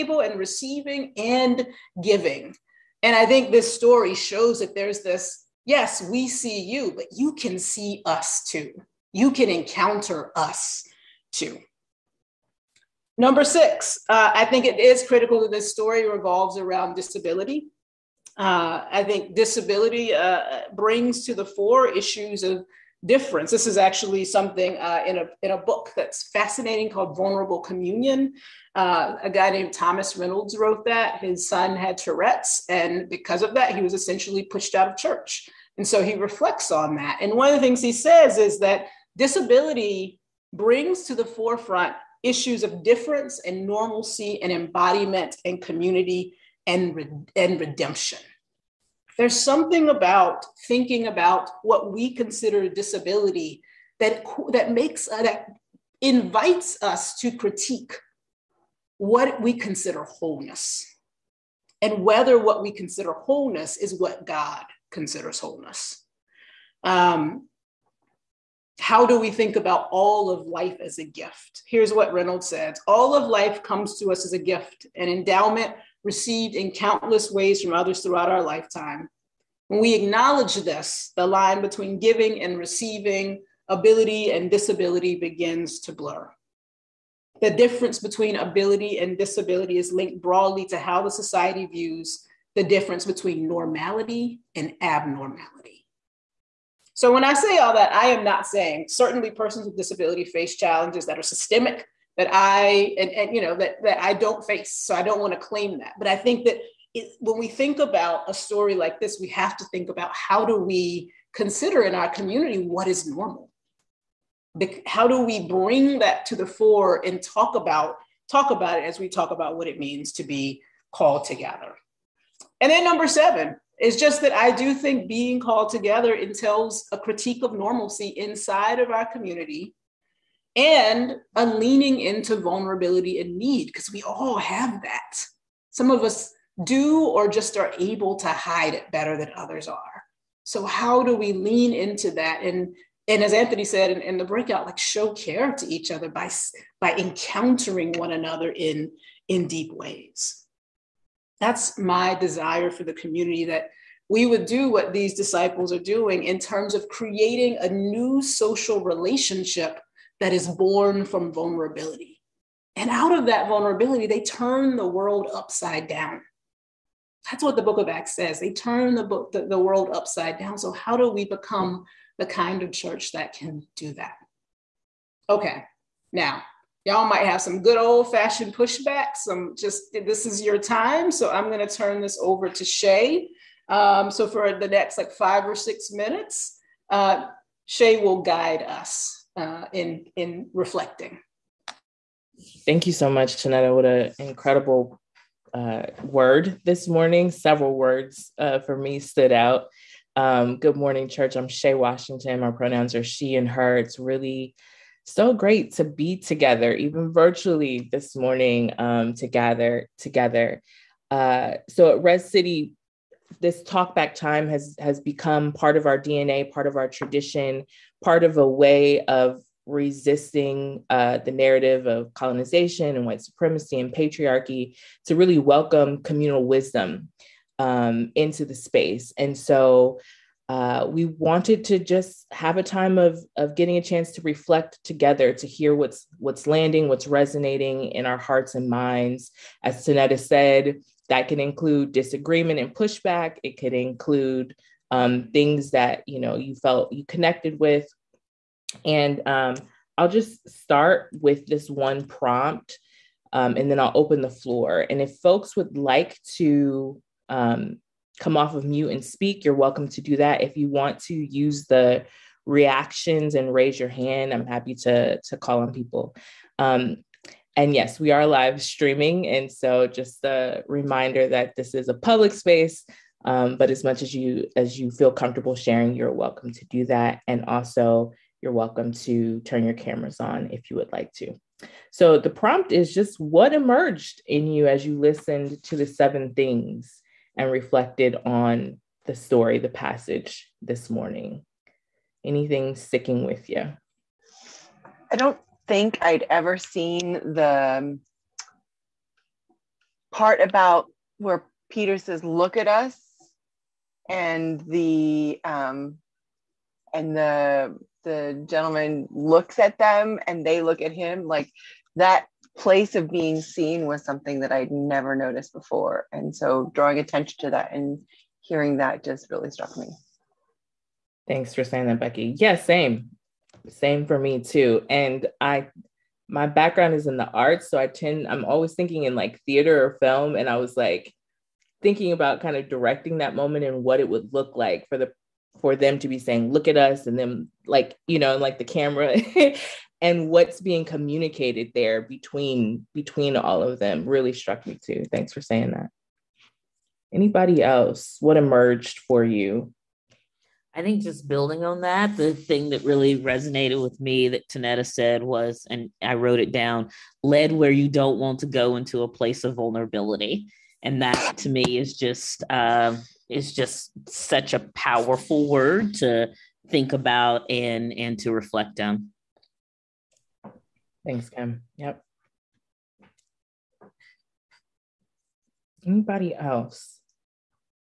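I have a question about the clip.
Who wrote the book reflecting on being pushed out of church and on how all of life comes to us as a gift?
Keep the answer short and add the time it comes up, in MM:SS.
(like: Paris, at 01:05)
Thomas Reynolds, at 00:29.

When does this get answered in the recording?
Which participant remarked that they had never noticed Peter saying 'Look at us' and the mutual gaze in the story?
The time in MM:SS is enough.
05:21.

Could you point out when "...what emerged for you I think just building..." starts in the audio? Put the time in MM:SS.
05:48.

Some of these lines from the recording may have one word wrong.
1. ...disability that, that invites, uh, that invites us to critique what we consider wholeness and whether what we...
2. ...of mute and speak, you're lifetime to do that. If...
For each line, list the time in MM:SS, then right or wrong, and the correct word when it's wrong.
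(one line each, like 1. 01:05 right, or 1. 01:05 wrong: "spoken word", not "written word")
1. 00:52 wrong: "makes", not "invites"
2. 04:18 wrong: "welcome", not "lifetime".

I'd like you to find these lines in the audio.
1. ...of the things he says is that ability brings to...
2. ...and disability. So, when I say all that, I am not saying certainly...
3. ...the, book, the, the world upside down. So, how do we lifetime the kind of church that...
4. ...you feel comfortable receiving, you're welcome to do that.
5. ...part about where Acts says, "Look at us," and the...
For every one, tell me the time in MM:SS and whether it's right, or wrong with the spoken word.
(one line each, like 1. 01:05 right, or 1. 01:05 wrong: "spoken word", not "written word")
1. 00:37 wrong: "disability", not "ability"
2. 01:34 wrong: "abnormality", not "disability"
3. 02:48 wrong: "become", not "lifetime"
4. 04:34 wrong: "sharing", not "receiving"
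5. 05:00 wrong: "Peter", not "Acts".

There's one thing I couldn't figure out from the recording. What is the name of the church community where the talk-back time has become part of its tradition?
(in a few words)
Red City.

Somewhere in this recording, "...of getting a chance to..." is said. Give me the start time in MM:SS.
03:53.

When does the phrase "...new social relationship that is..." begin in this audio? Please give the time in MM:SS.
02:37.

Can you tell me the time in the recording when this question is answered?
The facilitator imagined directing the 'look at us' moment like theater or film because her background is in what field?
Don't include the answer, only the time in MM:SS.
05:27.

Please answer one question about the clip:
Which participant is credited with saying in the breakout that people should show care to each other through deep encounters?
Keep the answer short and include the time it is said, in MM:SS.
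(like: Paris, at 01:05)
Anthony, at 02:23.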